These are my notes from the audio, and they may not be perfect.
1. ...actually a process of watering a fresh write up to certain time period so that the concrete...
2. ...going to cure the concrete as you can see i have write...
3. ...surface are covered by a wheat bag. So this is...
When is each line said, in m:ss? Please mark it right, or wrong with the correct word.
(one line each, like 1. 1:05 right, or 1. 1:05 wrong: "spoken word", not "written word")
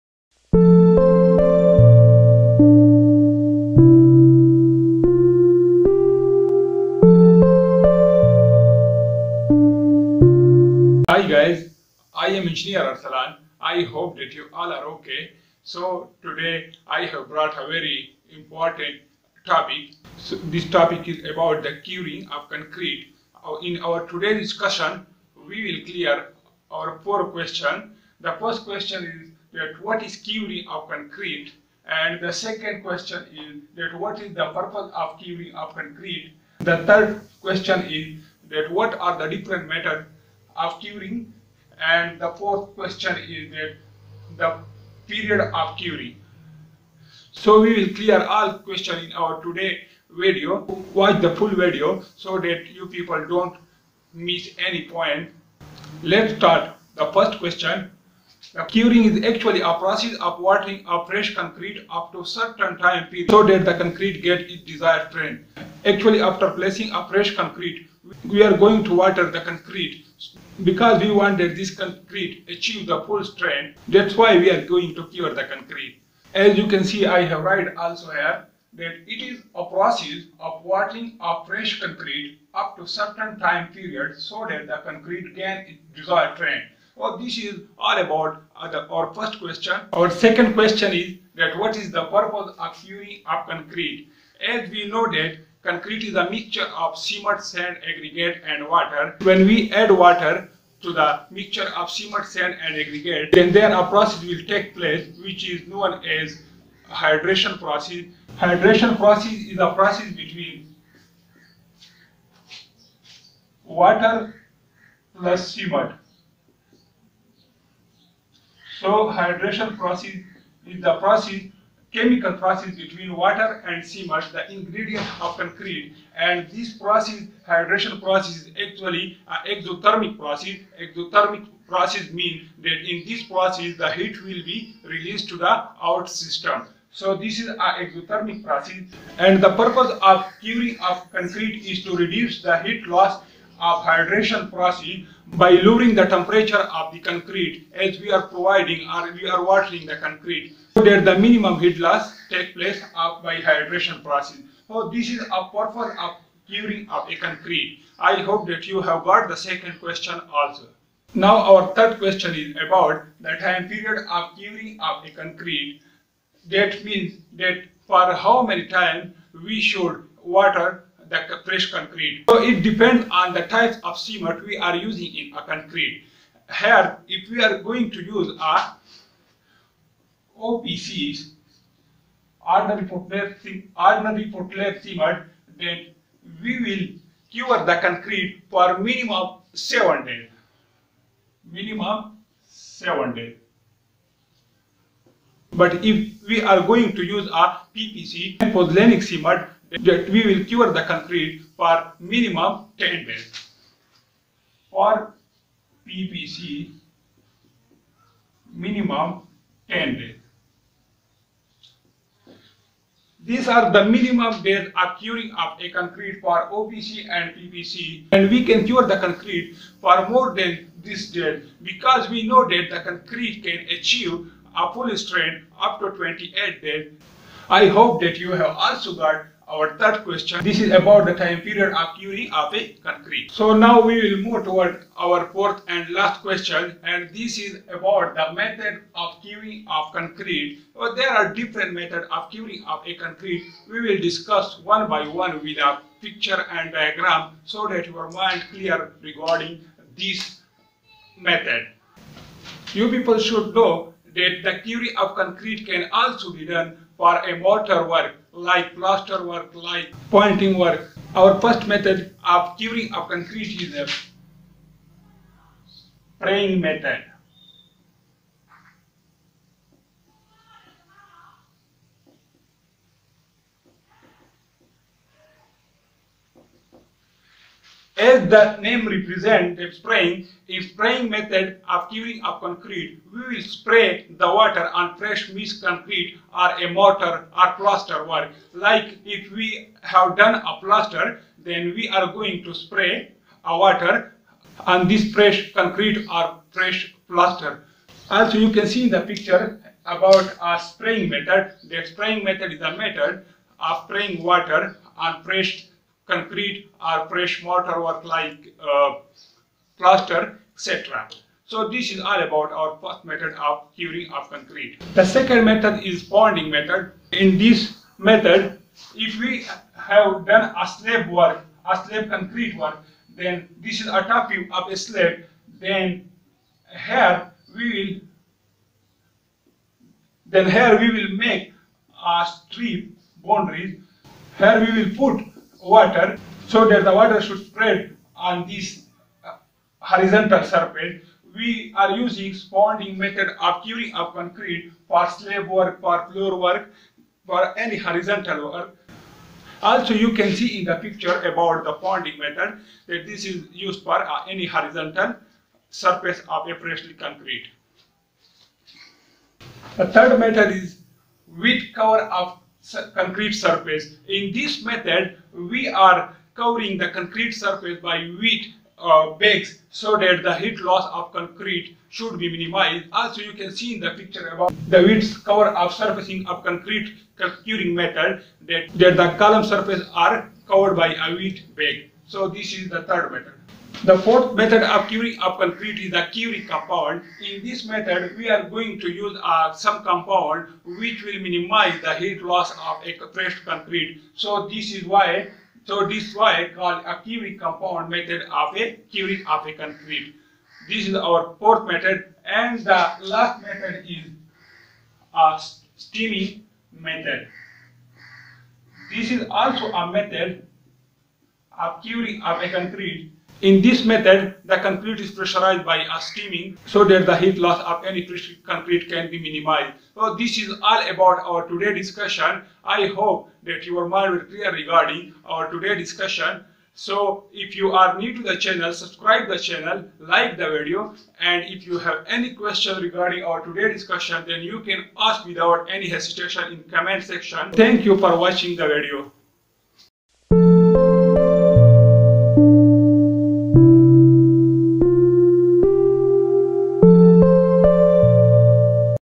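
1. 0:59 wrong: "concrete", not "write"
2. 1:14 right
3. 6:19 right.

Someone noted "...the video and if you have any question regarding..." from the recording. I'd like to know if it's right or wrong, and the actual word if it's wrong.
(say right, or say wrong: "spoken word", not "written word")
right.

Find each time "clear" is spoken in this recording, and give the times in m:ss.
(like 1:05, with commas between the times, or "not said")
0:25, 0:47, 4:08, 7:04.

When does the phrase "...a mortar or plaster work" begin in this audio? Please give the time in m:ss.
4:46.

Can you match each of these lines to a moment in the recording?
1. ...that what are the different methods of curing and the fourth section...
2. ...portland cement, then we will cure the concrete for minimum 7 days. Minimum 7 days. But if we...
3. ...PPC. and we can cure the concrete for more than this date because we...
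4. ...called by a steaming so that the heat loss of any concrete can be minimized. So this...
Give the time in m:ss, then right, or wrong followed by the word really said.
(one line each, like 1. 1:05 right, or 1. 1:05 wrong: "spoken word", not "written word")
1. 0:38 wrong: "question", not "section"
2. 3:04 right
3. 3:37 right
4. 6:55 wrong: "pressurized", not "called".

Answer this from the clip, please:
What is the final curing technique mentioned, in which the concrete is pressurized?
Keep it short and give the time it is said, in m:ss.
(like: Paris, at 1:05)
Steaming method, at 6:45.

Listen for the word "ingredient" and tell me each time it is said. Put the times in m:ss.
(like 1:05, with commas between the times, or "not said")
2:04.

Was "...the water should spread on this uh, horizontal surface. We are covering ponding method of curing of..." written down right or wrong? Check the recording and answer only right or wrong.
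wrong.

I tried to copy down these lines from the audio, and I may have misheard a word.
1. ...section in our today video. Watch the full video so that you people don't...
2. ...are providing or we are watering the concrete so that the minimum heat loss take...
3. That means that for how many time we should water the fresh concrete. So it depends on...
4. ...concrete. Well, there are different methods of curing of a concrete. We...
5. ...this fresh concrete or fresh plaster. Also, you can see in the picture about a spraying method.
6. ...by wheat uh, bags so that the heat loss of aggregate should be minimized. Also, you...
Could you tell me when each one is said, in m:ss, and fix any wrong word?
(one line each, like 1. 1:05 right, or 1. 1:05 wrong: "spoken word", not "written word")
1. 0:48 wrong: "question", not "section"
2. 2:28 right
3. 2:46 right
4. 3:59 right
5. 4:54 right
6. 6:07 wrong: "concrete", not "aggregate".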